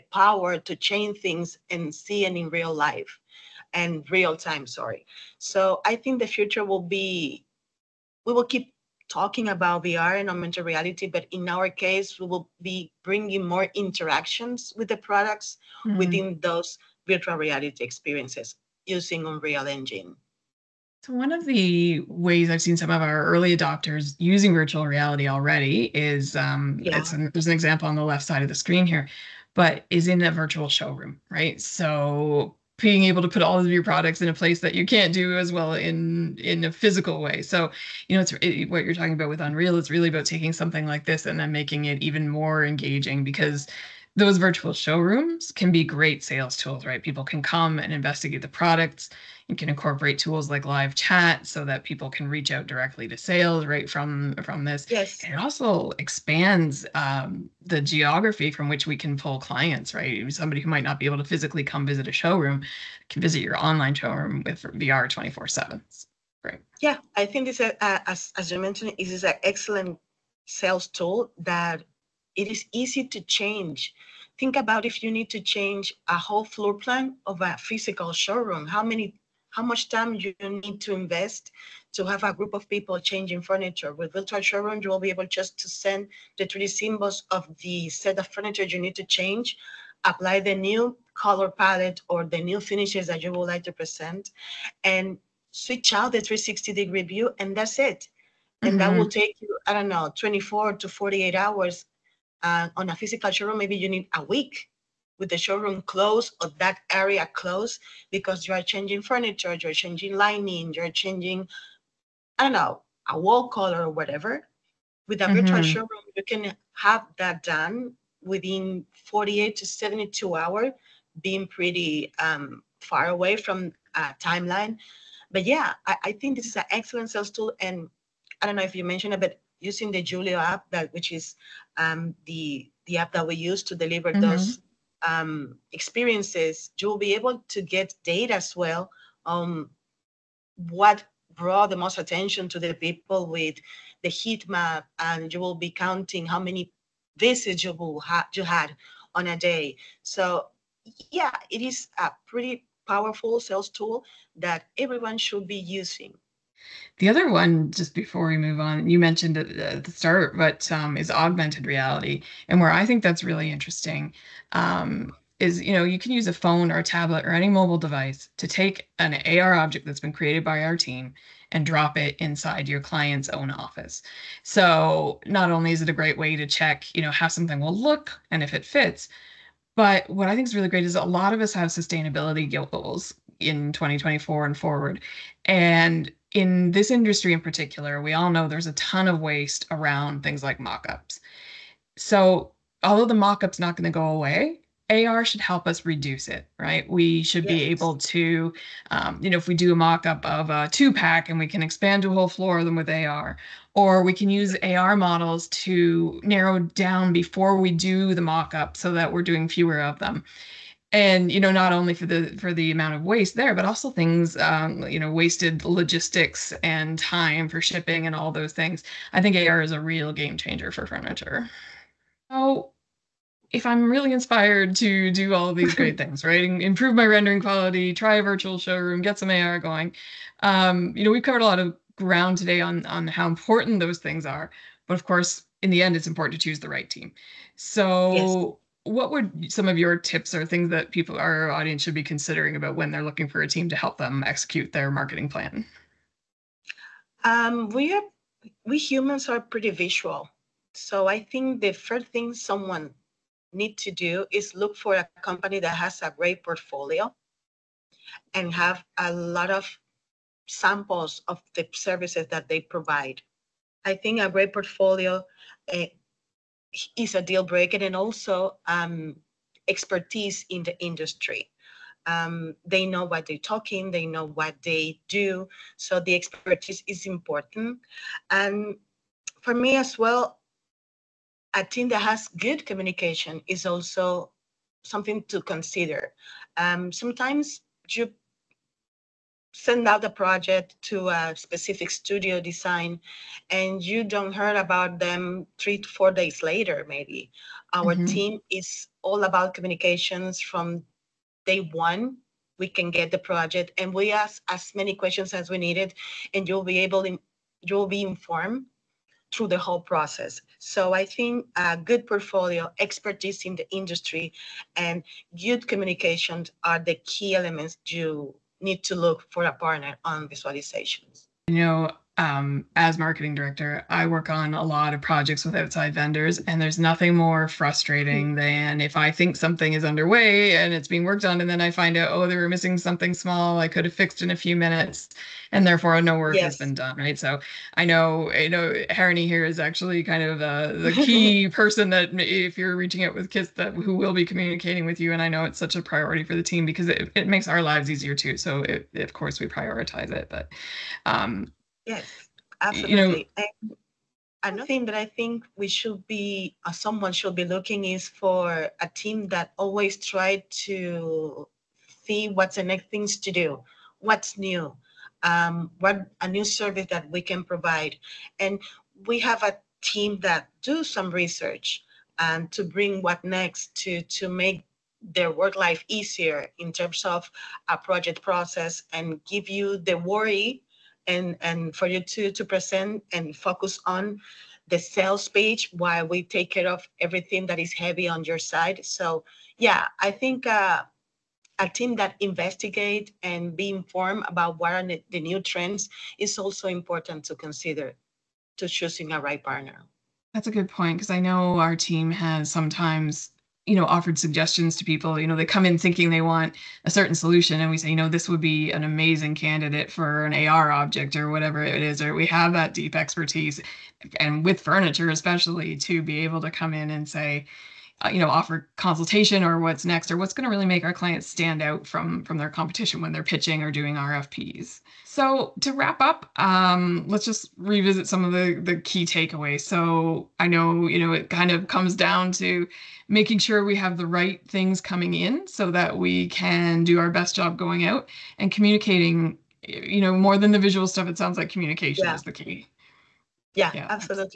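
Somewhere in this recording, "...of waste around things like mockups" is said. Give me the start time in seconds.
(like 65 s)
189 s.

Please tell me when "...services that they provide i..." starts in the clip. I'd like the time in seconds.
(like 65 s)
261 s.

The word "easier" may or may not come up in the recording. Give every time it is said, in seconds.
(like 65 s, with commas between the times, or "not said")
347 s, 375 s.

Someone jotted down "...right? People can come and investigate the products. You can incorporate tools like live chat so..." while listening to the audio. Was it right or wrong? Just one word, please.
right.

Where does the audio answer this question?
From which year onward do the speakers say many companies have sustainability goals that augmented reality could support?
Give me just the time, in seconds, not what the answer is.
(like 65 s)
183 s.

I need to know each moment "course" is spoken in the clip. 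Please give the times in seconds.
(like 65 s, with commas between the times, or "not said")
235 s, 349 s.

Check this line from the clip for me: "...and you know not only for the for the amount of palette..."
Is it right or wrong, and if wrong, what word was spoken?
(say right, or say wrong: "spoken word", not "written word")
wrong: "waste", not "palette".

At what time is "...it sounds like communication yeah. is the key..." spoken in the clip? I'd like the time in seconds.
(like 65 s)
441 s.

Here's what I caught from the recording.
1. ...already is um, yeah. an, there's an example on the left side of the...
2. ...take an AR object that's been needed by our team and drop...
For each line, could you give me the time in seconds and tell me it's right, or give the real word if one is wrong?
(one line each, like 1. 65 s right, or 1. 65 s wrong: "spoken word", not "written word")
1. 25 s right
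2. 168 s wrong: "created", not "needed".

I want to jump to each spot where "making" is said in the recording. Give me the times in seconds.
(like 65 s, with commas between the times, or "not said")
41 s, 433 s.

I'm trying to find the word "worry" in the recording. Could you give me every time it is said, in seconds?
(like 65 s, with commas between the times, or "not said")
379 s.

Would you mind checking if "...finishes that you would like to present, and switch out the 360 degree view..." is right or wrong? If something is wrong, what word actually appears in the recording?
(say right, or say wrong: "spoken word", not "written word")
right.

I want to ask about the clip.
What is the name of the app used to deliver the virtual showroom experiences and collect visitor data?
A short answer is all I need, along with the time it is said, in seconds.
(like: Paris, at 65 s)
Yulio, at 130 s.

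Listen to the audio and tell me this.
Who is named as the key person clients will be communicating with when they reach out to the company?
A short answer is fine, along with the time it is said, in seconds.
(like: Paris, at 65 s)
Harini, at 338 s.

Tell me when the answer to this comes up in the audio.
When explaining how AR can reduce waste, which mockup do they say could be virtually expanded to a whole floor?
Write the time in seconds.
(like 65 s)
200 s.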